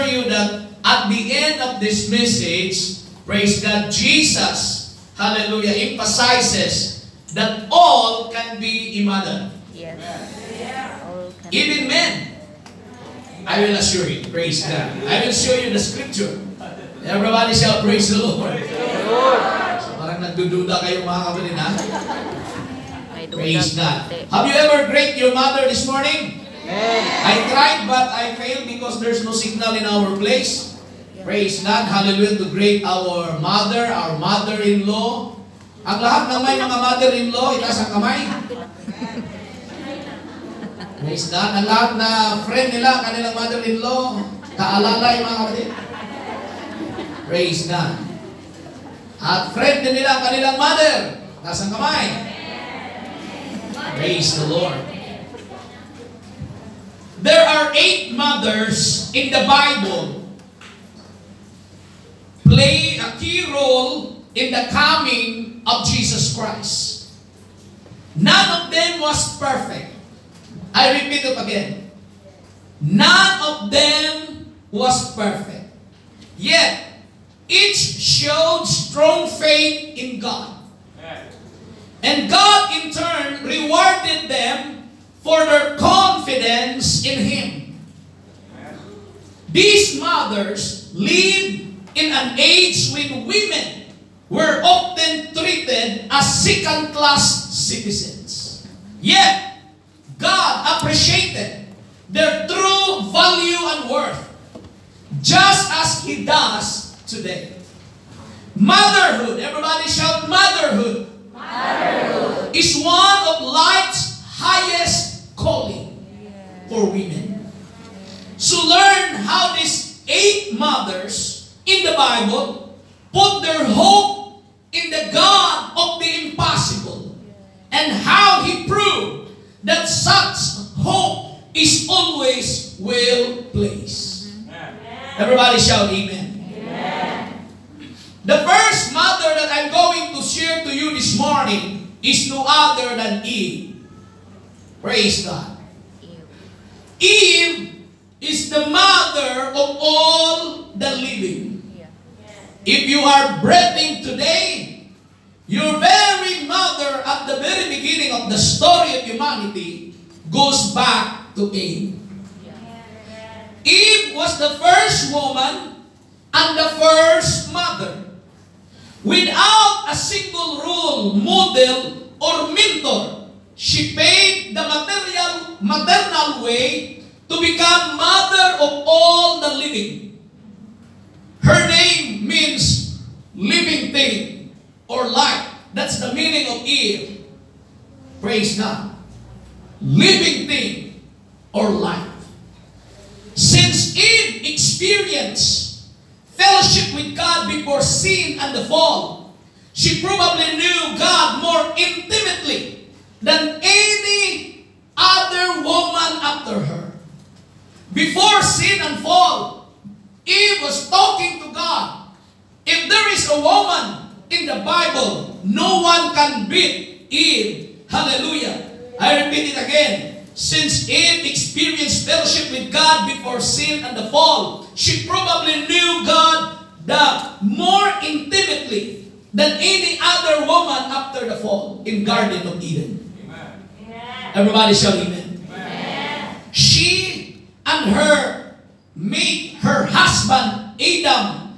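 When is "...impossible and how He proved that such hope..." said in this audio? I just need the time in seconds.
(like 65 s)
126 s.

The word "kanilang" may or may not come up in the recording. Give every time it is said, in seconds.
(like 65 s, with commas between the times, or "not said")
43 s, 50 s.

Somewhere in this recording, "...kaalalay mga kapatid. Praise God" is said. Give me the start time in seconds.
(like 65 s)
44 s.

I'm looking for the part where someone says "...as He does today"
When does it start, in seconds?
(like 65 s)
105 s.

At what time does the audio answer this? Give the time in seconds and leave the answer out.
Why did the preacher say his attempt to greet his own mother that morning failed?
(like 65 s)
29 s.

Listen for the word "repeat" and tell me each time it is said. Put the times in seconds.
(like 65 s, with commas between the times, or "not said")
70 s, 219 s.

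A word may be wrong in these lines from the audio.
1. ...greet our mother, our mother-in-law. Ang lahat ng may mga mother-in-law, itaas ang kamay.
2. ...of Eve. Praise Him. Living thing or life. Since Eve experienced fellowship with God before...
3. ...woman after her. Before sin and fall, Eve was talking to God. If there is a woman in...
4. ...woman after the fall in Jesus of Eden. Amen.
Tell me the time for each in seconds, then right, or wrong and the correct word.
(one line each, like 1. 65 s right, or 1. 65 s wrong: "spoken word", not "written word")
1. 32 s right
2. 186 s wrong: "God", not "Him"
3. 205 s right
4. 230 s wrong: "Garden", not "Jesus".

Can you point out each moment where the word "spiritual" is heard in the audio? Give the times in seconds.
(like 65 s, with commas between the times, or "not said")
not said.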